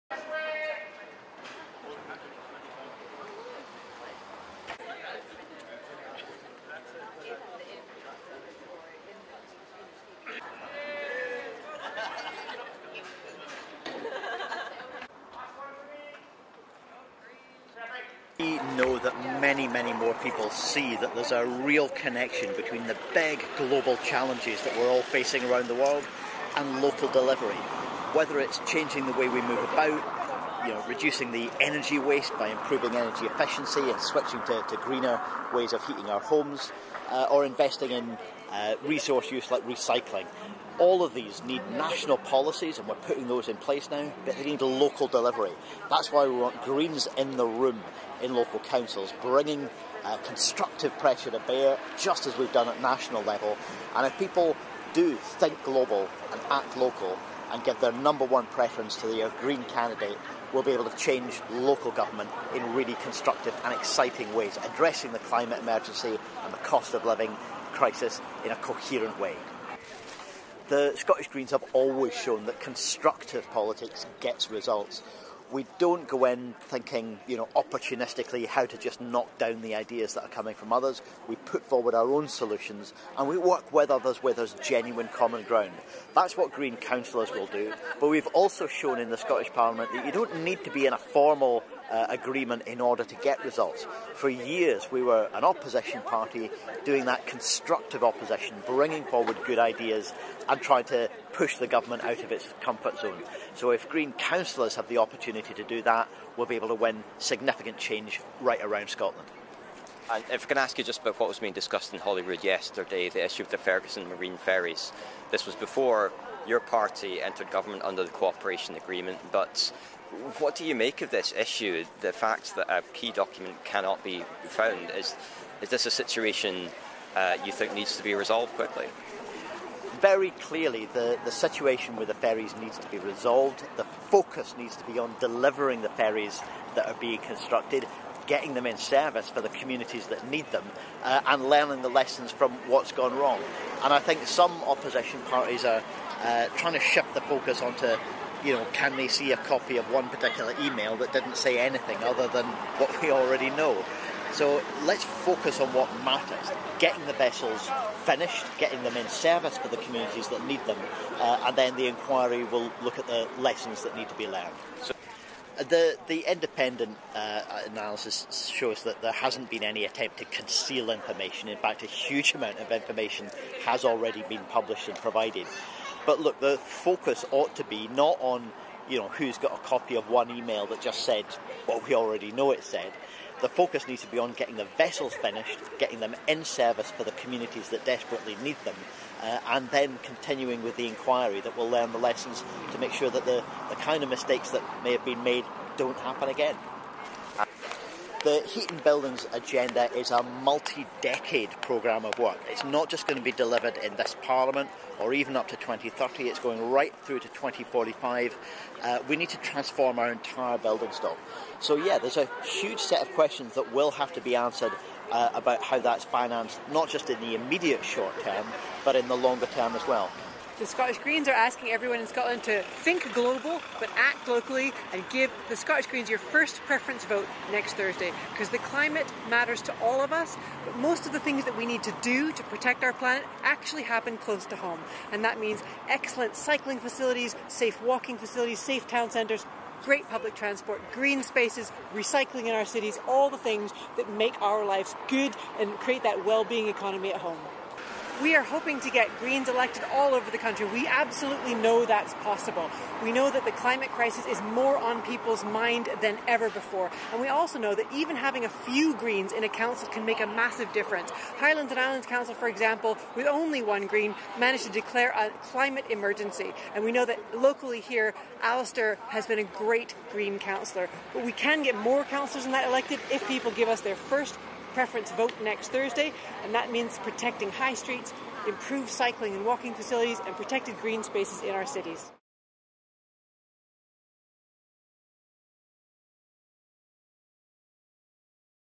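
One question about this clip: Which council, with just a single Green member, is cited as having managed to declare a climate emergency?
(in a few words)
Highlands and Islands Council.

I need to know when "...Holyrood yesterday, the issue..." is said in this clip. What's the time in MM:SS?
01:51.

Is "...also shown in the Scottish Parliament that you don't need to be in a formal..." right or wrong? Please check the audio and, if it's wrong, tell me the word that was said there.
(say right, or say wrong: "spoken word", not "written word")
right.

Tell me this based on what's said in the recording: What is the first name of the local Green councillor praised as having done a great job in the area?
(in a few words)
Alistair.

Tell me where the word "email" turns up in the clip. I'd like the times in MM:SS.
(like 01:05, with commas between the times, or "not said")
02:30, 03:00.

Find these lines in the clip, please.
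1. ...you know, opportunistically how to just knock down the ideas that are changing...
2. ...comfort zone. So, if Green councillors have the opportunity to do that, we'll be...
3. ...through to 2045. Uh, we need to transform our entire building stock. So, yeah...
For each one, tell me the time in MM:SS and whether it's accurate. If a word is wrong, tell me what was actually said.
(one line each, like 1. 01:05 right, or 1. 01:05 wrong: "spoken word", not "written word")
1. 01:17 wrong: "coming", not "changing"
2. 01:42 right
3. 03:27 right.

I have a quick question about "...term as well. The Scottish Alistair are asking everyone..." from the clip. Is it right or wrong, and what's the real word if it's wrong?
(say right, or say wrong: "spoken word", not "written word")
wrong: "Greens", not "Alistair".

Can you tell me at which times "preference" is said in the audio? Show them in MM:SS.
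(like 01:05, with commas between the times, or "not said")
00:58, 03:46, 04:34.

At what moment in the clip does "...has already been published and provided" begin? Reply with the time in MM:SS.
02:53.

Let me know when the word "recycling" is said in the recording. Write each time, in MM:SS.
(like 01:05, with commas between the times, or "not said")
00:39, 04:01.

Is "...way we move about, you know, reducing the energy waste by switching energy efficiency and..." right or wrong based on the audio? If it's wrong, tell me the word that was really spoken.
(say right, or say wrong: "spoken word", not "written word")
wrong: "improving", not "switching".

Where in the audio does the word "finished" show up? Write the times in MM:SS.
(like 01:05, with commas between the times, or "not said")
02:38, 03:05.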